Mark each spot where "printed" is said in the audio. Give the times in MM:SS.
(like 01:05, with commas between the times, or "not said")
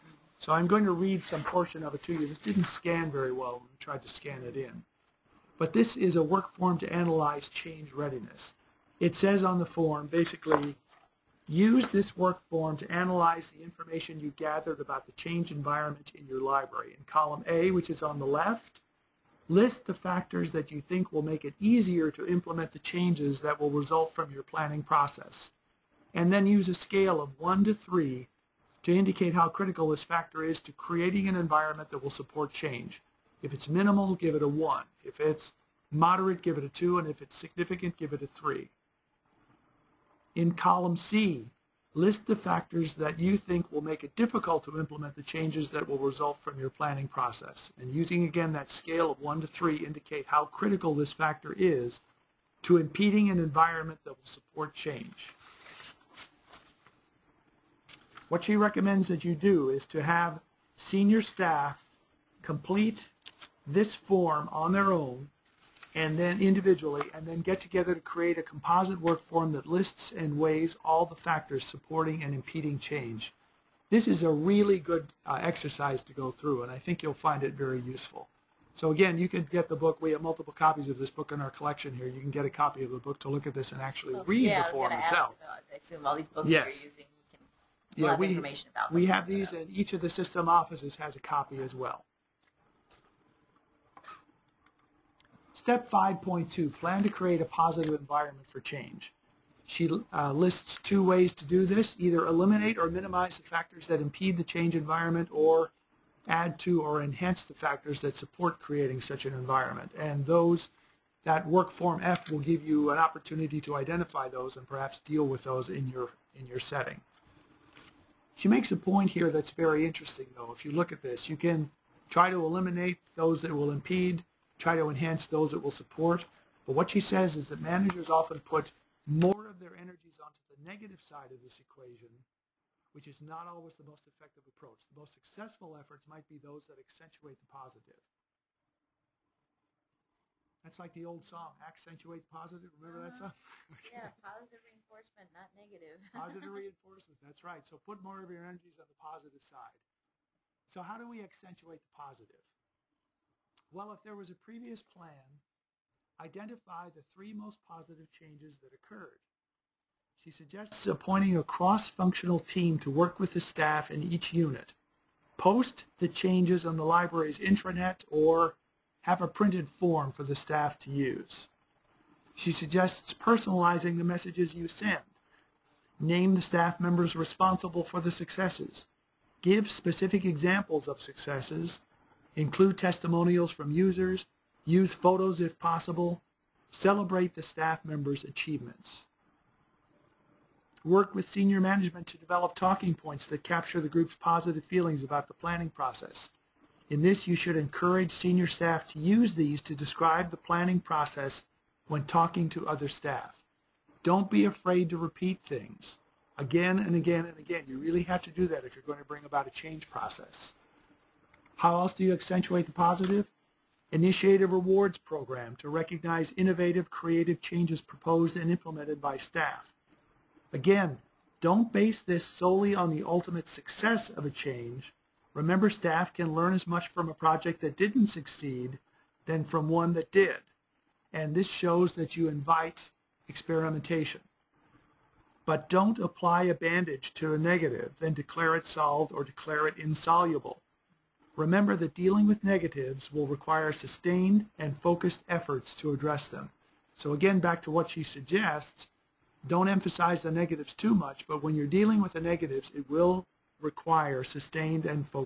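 02:49.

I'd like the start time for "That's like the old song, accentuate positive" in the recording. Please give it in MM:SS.
02:20.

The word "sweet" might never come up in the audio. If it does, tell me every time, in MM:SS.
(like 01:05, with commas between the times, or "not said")
not said.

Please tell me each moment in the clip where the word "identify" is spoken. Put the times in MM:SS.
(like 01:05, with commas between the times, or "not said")
01:53, 02:36.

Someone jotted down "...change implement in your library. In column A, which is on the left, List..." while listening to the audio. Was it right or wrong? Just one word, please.
wrong.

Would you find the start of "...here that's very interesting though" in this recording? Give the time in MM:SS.
01:59.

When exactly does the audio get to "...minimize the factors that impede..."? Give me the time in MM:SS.
01:42.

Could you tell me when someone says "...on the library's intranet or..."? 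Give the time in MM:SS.
02:46.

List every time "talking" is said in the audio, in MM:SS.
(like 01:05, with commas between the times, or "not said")
03:12, 03:22.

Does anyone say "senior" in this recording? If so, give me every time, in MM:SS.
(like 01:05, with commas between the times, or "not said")
01:00, 03:11, 03:18.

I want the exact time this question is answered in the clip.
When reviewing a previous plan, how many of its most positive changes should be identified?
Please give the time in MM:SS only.
02:37.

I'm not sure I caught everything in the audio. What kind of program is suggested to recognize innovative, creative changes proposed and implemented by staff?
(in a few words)
rewards program.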